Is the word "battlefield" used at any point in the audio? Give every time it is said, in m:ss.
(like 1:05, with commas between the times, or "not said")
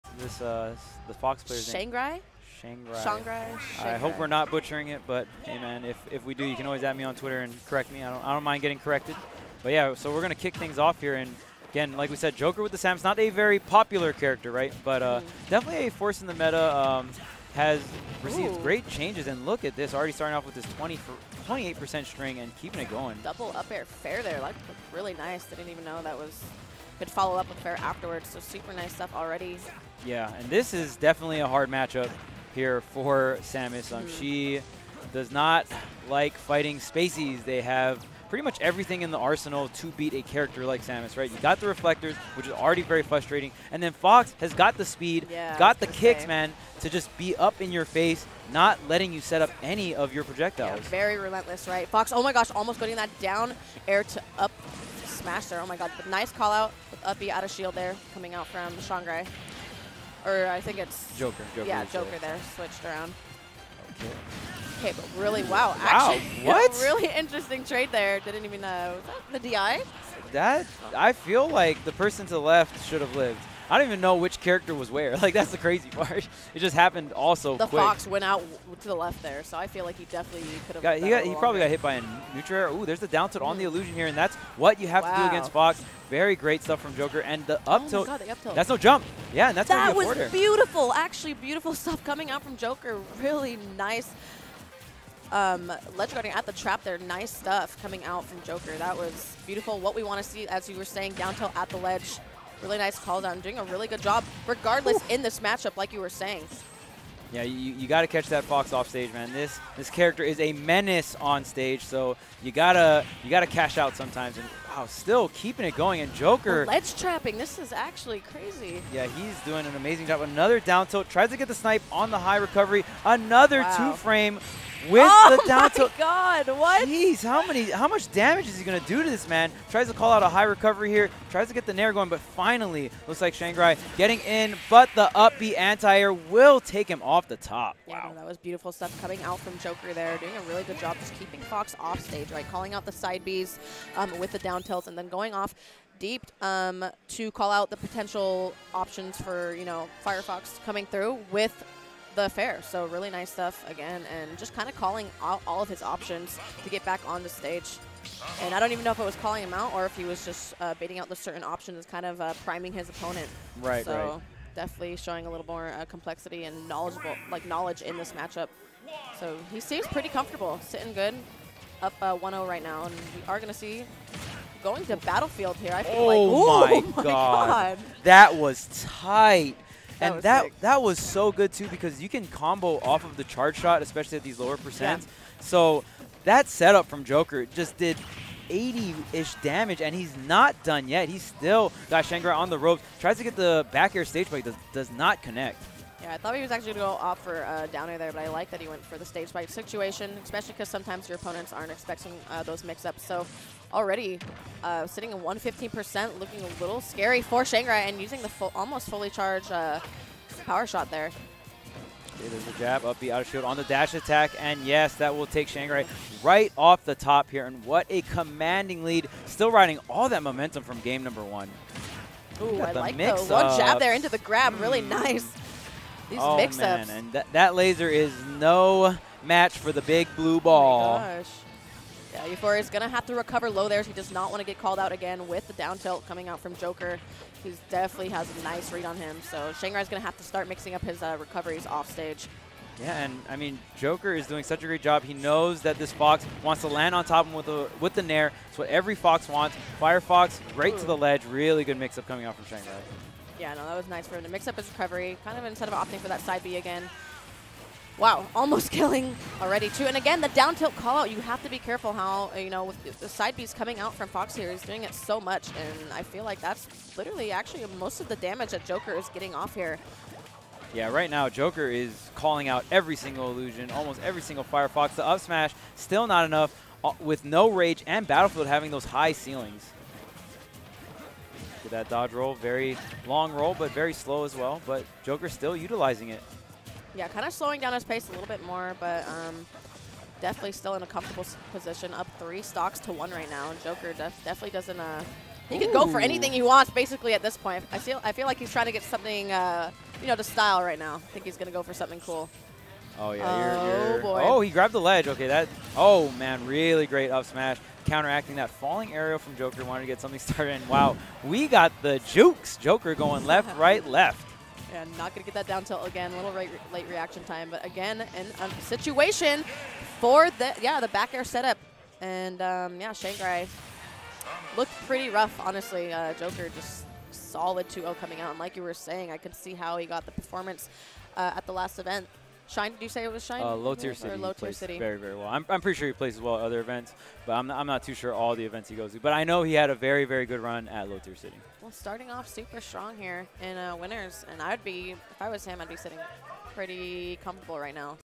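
2:54, 4:38.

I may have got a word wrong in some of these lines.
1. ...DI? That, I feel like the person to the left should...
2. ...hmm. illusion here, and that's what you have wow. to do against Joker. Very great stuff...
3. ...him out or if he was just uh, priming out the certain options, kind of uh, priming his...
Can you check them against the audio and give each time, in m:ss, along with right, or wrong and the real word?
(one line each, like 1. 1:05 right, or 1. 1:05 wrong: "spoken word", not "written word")
1. 1:09 right
2. 1:23 wrong: "Fox", not "Joker"
3. 2:39 wrong: "baiting", not "priming".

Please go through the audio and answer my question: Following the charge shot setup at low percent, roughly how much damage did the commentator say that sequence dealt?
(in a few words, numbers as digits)
80.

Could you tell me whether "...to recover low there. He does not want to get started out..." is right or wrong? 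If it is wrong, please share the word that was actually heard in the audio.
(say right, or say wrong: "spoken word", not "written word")
wrong: "called", not "started".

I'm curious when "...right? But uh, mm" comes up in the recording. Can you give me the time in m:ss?
0:14.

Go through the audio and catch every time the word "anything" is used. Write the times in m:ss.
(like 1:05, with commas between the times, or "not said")
4:55.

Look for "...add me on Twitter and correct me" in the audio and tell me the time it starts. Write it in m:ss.
0:06.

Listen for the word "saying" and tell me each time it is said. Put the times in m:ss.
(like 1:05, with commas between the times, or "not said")
1:40, 1:46, 5:28.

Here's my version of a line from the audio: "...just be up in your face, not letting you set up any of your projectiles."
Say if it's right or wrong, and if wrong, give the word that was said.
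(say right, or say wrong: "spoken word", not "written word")
right.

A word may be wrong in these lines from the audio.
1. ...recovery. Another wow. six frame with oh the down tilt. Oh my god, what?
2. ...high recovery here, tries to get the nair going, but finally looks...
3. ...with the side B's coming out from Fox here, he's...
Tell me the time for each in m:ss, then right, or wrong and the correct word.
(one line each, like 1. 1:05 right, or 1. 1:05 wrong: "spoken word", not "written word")
1. 2:02 wrong: "two", not "six"
2. 2:10 right
3. 4:22 right.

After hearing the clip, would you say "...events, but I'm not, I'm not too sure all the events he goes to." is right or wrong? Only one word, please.
right.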